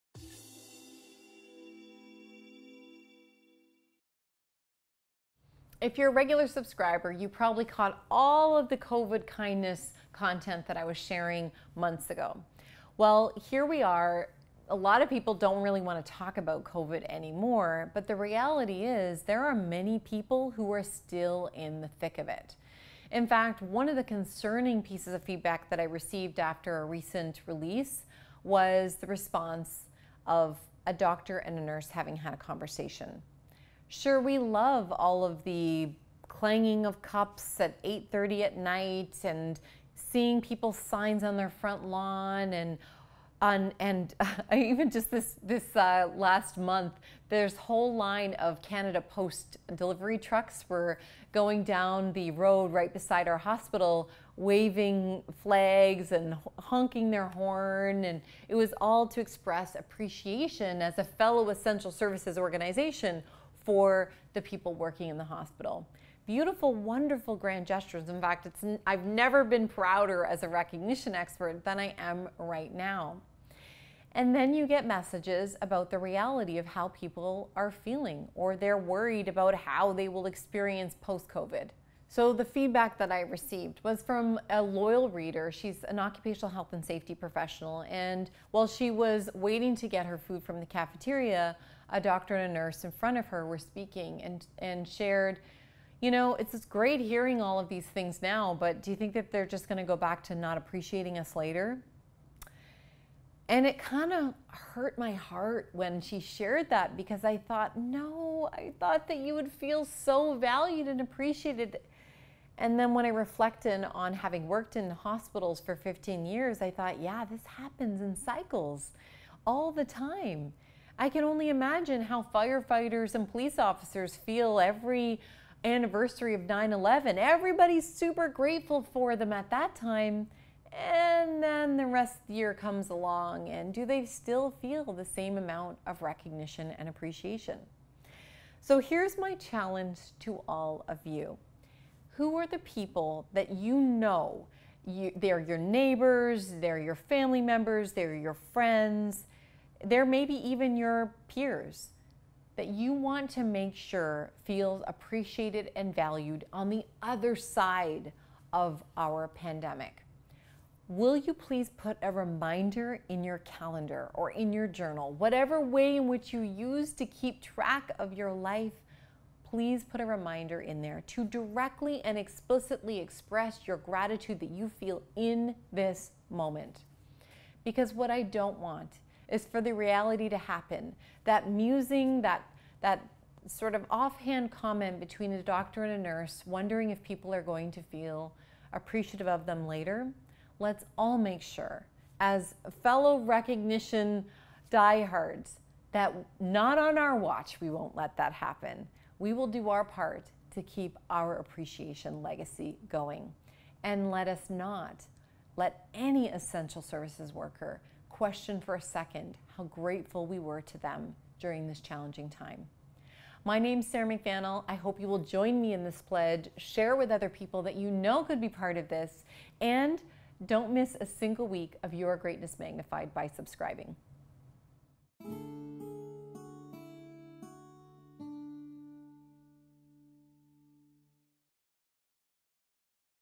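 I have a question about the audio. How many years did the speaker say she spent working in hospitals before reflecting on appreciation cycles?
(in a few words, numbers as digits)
15.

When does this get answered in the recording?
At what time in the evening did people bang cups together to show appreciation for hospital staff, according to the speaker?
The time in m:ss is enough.
0:37.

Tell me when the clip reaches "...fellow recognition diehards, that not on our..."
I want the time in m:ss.
3:12.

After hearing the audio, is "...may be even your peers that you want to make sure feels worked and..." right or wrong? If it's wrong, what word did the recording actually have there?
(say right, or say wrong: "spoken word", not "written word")
wrong: "appreciated", not "worked".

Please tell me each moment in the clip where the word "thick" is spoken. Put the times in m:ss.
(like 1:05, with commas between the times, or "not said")
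0:21.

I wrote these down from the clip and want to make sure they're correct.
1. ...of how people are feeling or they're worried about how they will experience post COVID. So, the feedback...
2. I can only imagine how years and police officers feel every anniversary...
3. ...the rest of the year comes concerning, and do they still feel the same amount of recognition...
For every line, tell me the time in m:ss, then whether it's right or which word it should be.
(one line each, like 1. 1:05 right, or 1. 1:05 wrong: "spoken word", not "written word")
1. 1:16 right
2. 2:01 wrong: "firefighters", not "years"
3. 2:11 wrong: "along", not "concerning".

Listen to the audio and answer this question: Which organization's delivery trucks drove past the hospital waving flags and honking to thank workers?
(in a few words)
Canada Post.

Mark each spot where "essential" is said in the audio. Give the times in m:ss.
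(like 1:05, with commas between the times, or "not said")
1:01, 3:26.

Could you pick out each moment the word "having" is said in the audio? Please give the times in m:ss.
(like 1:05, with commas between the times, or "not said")
0:31, 1:54.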